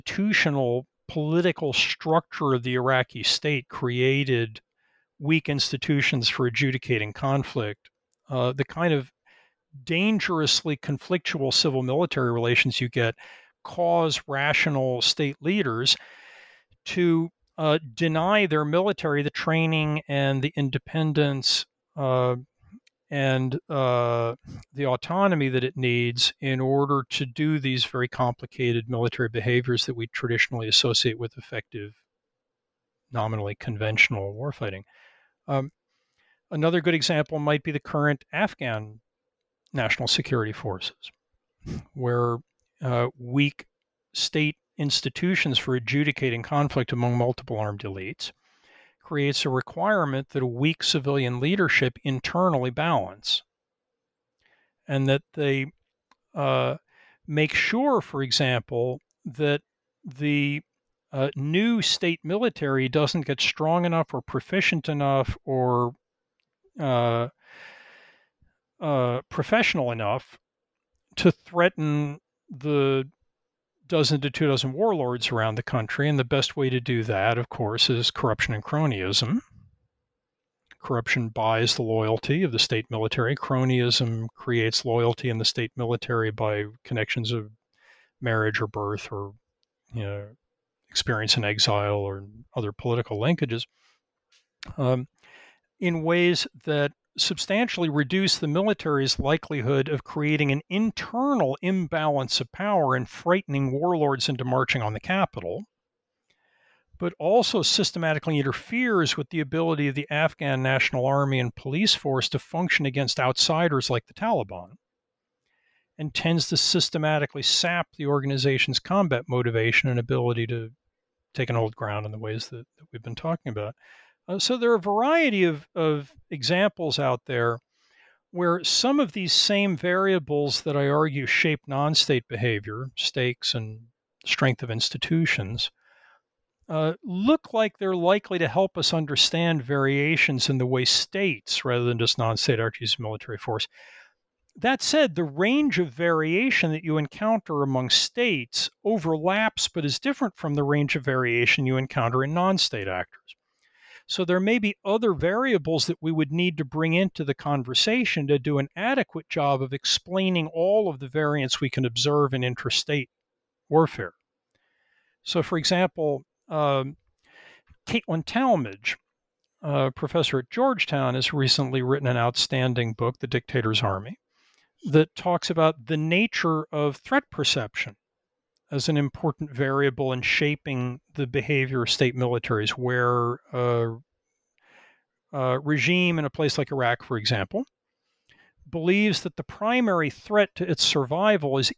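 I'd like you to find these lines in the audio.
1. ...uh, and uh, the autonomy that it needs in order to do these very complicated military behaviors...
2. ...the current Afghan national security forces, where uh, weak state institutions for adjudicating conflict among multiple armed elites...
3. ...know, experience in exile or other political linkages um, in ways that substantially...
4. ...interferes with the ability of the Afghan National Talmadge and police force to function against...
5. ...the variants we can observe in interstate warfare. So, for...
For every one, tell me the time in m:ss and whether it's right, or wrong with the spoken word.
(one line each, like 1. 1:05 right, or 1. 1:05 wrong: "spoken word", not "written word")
1. 0:21 right
2. 0:37 right
3. 1:30 right
4. 1:48 wrong: "Army", not "Talmadge"
5. 2:40 right.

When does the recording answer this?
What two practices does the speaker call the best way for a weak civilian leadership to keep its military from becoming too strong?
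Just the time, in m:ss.
1:18.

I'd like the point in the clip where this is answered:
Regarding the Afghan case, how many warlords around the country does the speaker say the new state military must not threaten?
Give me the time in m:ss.
1:13.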